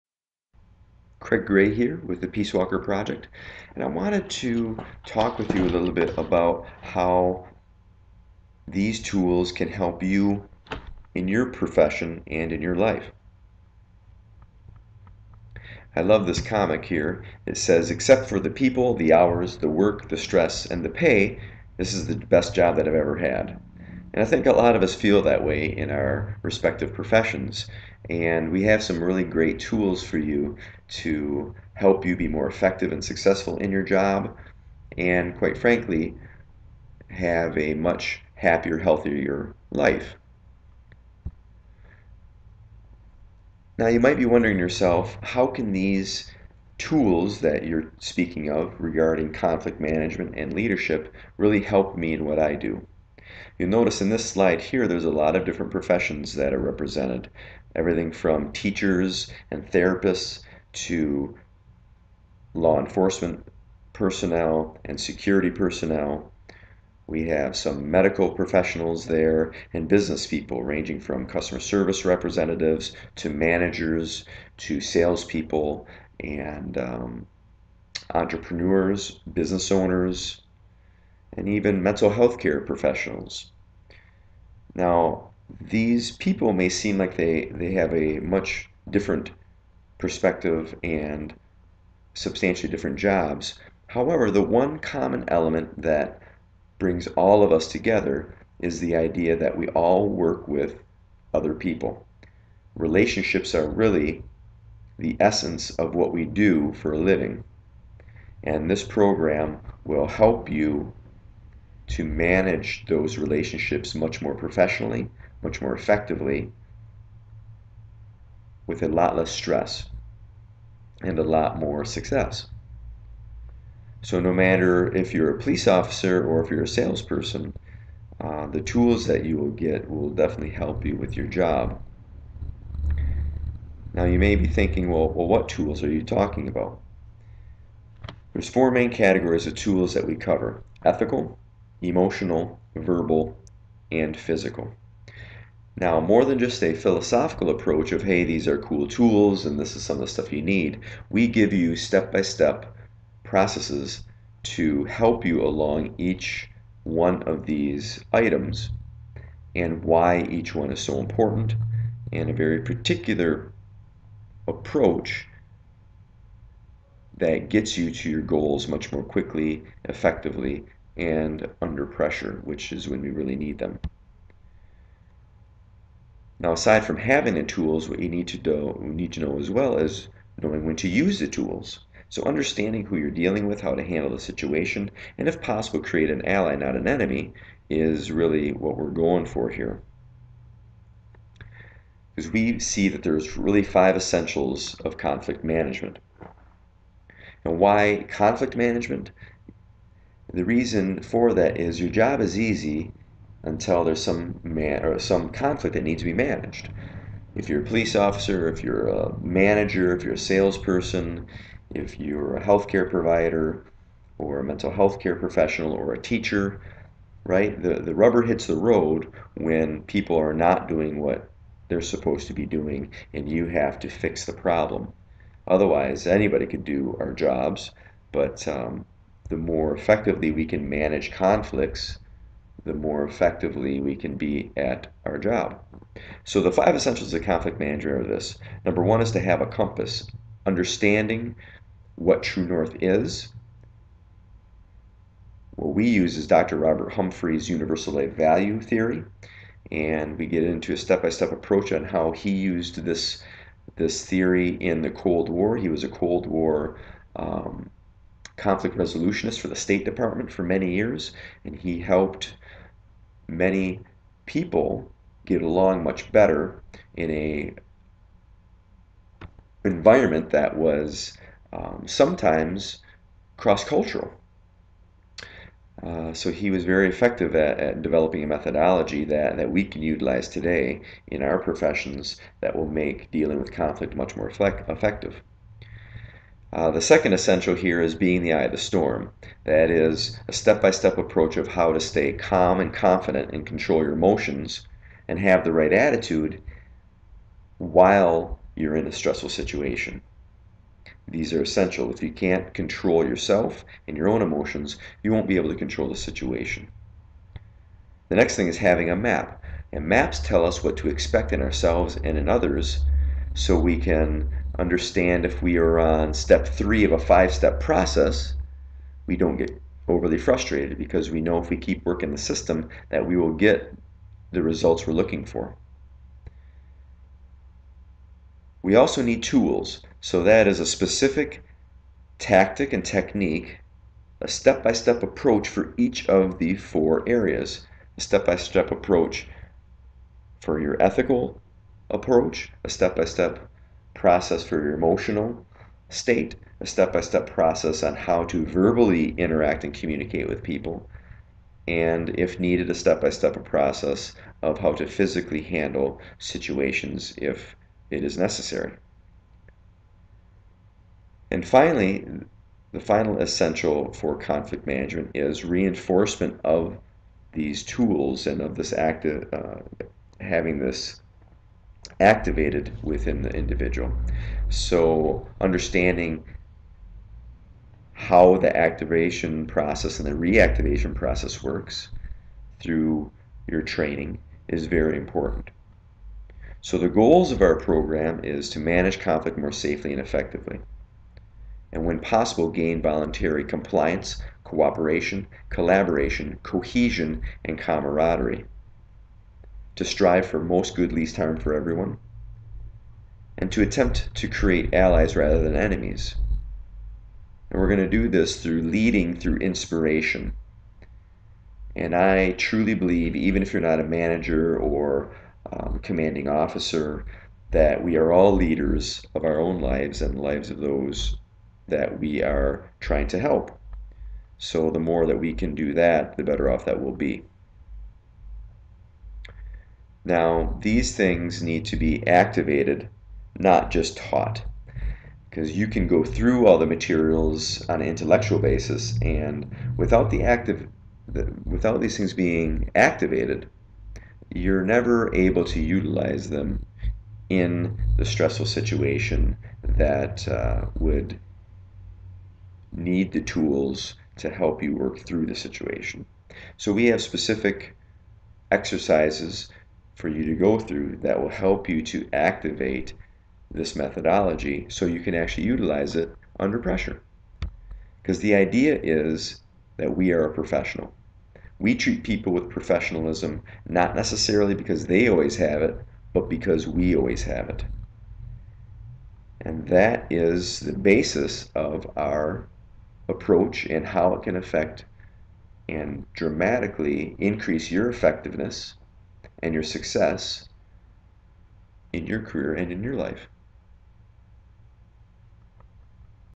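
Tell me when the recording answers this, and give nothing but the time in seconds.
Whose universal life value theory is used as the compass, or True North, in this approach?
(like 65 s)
246 s.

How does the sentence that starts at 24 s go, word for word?
And I think a lot of us feel that way in our respective professions.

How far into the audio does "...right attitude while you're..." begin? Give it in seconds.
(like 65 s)
295 s.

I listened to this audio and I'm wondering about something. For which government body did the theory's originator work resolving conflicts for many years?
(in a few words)
State Department.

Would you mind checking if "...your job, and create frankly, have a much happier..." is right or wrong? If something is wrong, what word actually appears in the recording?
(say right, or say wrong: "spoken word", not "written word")
wrong: "quite", not "create".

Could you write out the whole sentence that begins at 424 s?
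So the more that we can do that, the better off that we'll be.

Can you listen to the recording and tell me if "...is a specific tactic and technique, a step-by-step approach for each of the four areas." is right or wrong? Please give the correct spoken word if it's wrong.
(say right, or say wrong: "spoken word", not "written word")
right.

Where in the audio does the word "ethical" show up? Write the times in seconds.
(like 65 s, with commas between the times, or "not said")
140 s, 340 s.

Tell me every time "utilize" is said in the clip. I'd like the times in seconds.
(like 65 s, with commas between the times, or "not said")
279 s, 445 s, 465 s.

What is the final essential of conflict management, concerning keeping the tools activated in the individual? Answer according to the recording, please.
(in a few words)
reinforcement.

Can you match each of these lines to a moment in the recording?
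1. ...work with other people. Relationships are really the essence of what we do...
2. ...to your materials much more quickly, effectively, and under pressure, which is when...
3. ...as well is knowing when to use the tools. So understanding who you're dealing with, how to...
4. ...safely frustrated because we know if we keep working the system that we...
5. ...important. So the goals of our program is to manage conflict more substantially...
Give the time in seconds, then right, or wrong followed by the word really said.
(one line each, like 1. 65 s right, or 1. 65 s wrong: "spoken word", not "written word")
1. 100 s right
2. 167 s wrong: "goals", not "materials"
3. 179 s right
4. 319 s wrong: "overly", not "safely"
5. 384 s wrong: "safely", not "substantially".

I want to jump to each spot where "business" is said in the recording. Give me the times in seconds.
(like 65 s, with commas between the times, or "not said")
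69 s, 79 s.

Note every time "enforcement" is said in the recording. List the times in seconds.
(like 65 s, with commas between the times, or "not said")
62 s.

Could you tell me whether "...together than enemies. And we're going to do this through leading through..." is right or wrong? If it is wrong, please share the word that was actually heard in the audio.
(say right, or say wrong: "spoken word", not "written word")
wrong: "rather", not "together".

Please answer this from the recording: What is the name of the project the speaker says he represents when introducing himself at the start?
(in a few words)
PeaceWalker Project.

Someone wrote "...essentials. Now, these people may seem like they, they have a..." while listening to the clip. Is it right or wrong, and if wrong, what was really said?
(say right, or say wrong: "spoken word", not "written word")
wrong: "professionals", not "essentials".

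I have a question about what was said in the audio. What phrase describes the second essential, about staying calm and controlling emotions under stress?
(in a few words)
eye of the storm.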